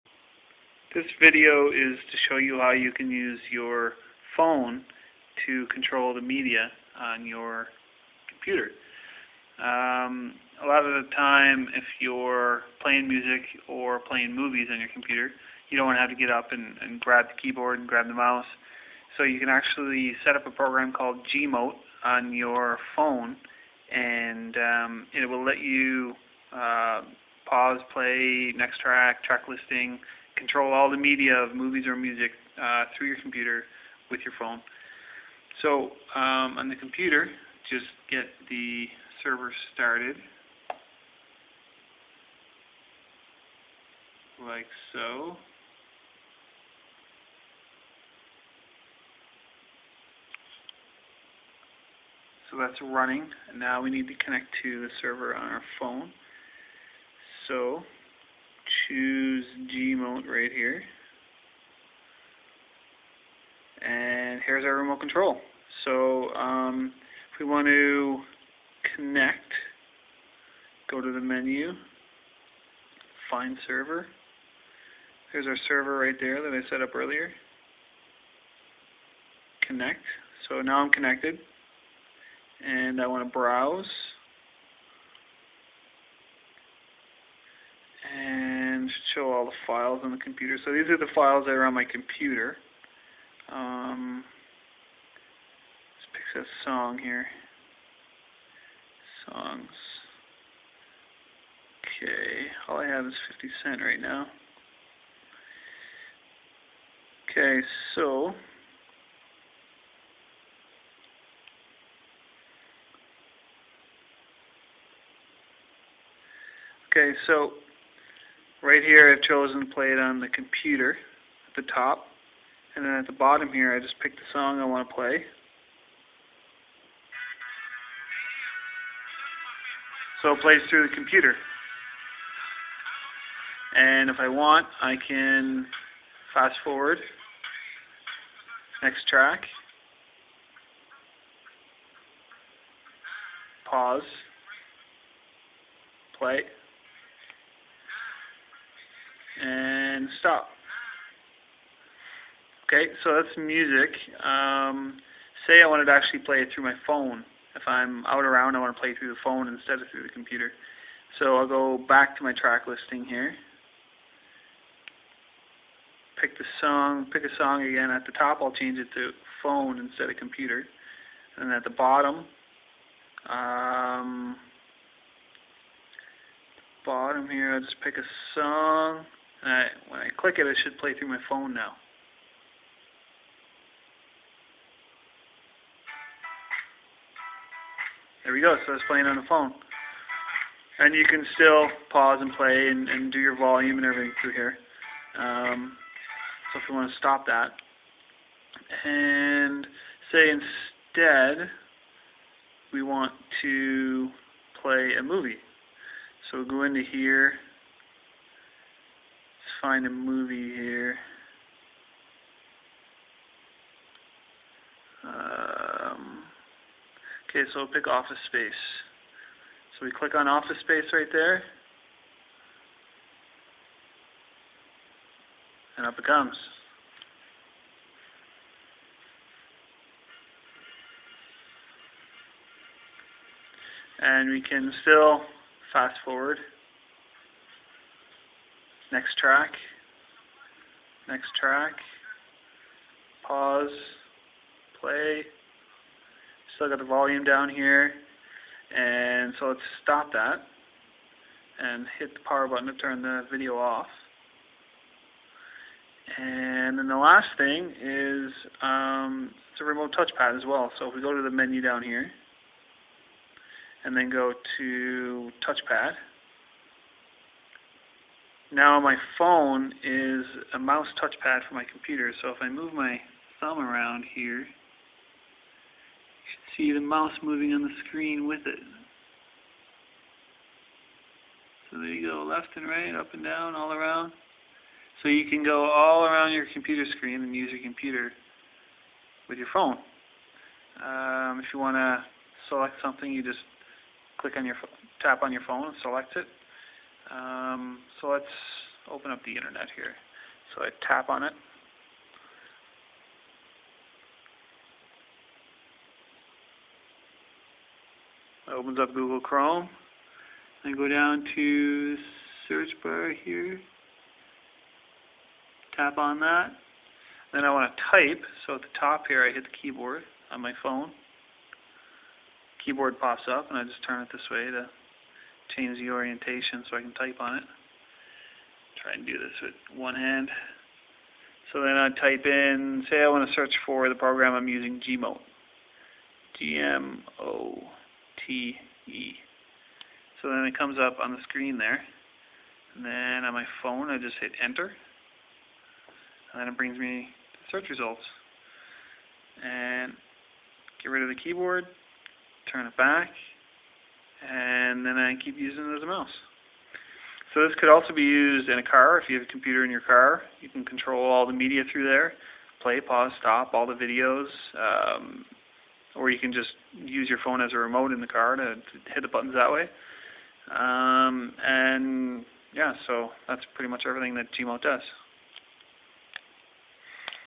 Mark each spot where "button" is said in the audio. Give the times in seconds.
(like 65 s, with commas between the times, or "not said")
252 s, 369 s.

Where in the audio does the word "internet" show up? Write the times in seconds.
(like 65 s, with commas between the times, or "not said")
299 s.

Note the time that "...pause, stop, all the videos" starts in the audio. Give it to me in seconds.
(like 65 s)
362 s.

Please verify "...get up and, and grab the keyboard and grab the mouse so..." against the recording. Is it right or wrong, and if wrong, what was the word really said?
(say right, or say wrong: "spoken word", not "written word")
right.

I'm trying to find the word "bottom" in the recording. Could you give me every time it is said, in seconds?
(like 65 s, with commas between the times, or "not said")
123 s, 171 s, 176 s.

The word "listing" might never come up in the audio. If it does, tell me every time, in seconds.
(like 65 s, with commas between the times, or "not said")
29 s, 162 s.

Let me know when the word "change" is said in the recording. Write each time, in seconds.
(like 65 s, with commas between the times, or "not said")
168 s, 325 s.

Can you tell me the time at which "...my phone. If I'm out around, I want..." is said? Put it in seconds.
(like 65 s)
156 s.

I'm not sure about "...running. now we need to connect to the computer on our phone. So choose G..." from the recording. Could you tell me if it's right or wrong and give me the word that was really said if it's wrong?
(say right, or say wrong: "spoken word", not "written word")
wrong: "server", not "computer".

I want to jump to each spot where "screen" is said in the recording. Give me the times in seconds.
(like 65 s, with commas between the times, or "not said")
277 s, 286 s, 341 s.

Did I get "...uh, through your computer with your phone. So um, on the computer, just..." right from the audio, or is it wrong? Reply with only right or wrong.
right.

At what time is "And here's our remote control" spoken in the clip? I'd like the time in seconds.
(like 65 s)
63 s.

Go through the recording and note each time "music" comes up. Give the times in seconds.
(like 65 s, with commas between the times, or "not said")
13 s, 31 s, 153 s.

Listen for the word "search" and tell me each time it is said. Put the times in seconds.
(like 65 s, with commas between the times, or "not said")
312 s, 333 s, 347 s.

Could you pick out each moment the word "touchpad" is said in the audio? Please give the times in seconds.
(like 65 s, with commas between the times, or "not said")
259 s, 265 s, 271 s.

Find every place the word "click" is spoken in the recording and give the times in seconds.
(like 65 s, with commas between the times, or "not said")
180 s, 219 s, 294 s.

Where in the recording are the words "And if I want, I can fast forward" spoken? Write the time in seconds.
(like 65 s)
133 s.